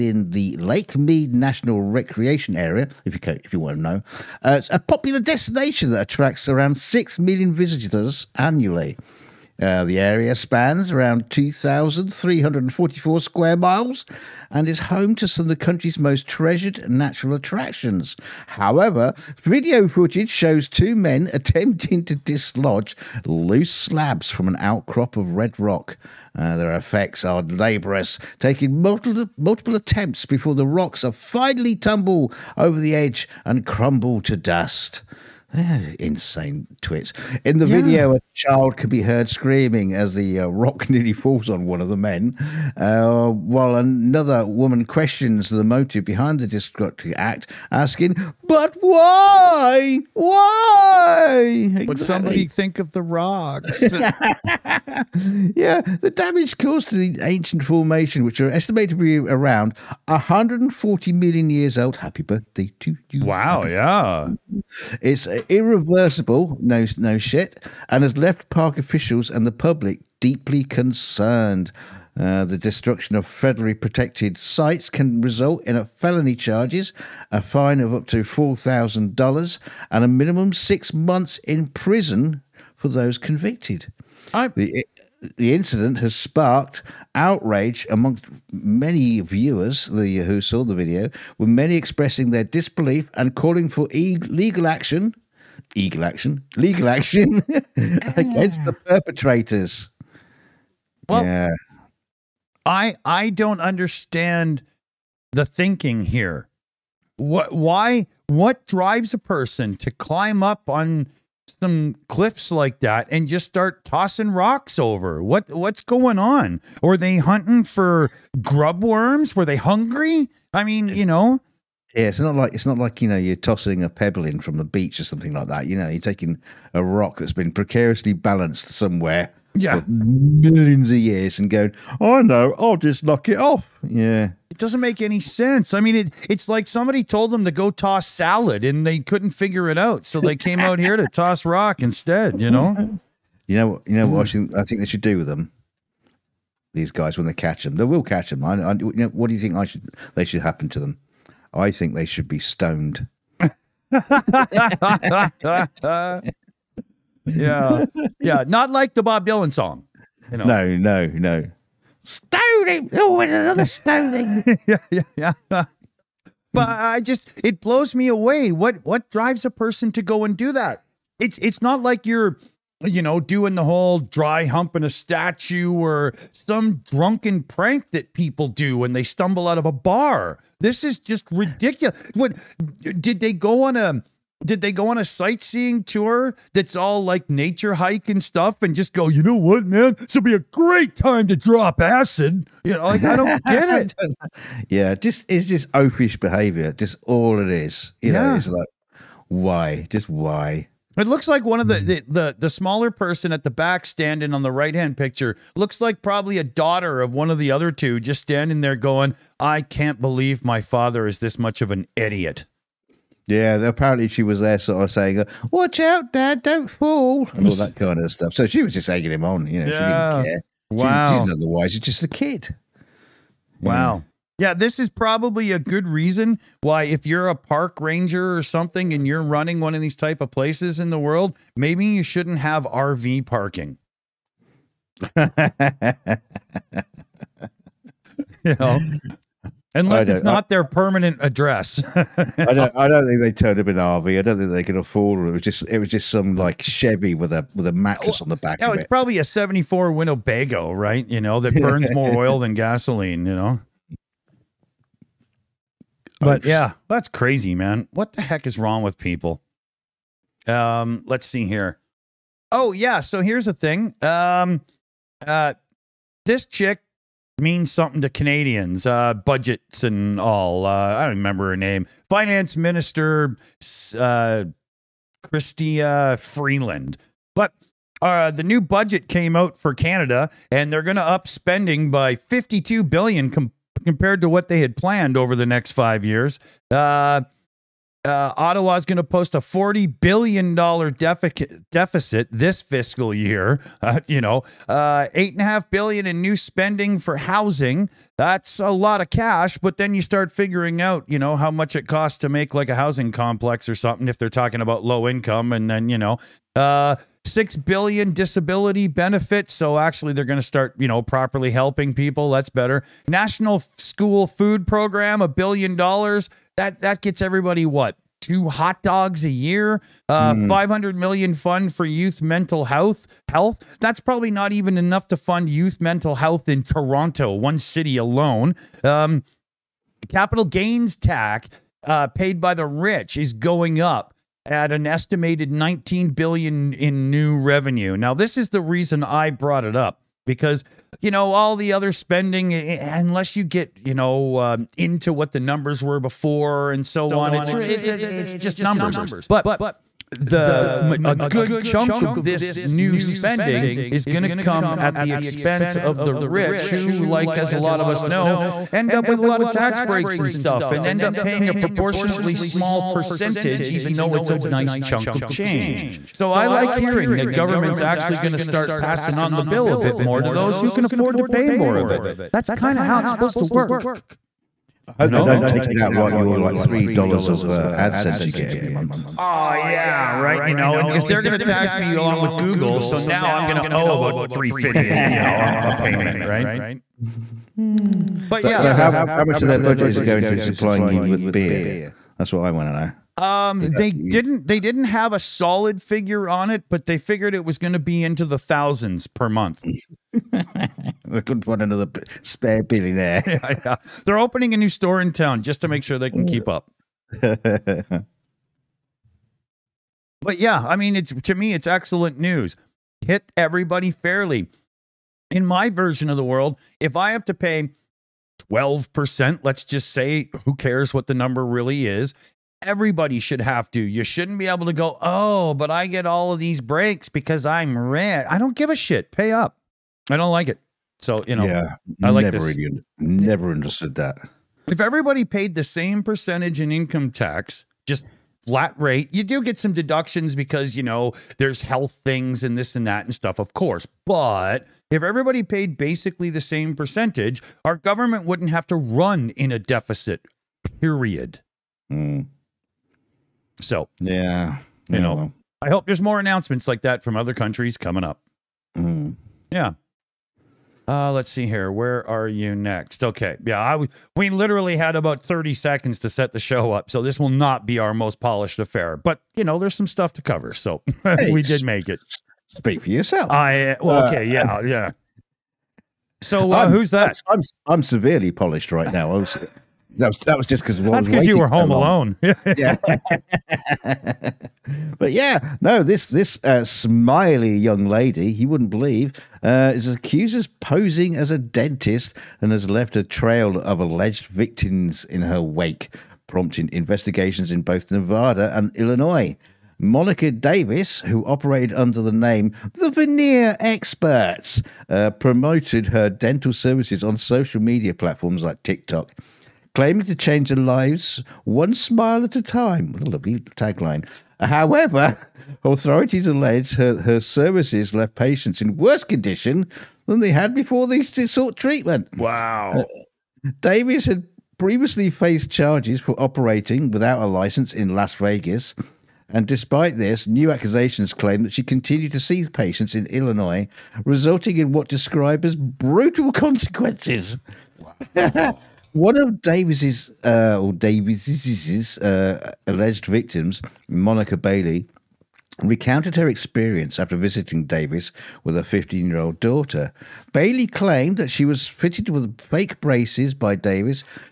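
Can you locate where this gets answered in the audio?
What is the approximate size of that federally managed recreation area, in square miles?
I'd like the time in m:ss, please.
0:11.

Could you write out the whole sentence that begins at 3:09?
This will be a great time to drop acid.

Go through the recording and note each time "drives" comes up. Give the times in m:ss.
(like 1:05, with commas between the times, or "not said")
1:48, 2:49.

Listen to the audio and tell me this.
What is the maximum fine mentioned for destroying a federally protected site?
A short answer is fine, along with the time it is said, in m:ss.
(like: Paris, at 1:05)
$4,000, at 1:18.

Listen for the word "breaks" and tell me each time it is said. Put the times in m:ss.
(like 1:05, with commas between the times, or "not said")
5:59, 7:06.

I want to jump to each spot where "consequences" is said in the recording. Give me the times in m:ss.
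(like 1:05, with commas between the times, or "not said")
8:56.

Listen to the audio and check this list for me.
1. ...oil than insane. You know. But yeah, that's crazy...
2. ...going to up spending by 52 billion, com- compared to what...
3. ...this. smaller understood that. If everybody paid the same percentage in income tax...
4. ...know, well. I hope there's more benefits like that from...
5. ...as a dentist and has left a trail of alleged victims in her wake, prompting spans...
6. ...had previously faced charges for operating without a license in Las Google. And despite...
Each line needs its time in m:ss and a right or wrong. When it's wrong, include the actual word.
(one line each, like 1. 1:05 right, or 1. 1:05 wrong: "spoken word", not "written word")
1. 4:12 wrong: "gasoline", not "insane"
2. 4:40 right
3. 7:12 wrong: "never", not "smaller"
4. 7:35 wrong: "announcements", not "benefits"
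5. 8:11 wrong: "investigations", not "spans"
6. 8:44 wrong: "Vegas", not "Google".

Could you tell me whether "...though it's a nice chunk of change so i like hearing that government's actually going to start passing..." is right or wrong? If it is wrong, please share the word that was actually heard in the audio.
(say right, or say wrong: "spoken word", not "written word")
right.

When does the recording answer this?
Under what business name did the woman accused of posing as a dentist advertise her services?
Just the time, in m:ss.
8:22.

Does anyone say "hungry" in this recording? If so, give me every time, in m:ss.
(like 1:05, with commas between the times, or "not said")
1:59.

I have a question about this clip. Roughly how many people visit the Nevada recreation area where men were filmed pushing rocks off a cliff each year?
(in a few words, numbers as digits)
6 million.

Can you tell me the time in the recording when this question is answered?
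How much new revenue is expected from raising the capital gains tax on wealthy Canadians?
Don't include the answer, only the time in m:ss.
5:35.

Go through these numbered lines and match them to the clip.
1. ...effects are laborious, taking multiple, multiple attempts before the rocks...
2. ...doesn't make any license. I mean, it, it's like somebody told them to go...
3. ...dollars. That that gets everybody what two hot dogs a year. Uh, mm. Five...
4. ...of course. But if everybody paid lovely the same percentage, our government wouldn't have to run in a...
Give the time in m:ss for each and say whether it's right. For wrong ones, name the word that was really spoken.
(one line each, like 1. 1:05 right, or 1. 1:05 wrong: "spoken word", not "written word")
1. 0:26 right
2. 2:14 wrong: "sense", not "license"
3. 5:15 right
4. 7:23 wrong: "basically", not "lovely".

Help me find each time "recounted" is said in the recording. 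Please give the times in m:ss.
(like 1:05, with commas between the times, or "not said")
9:05.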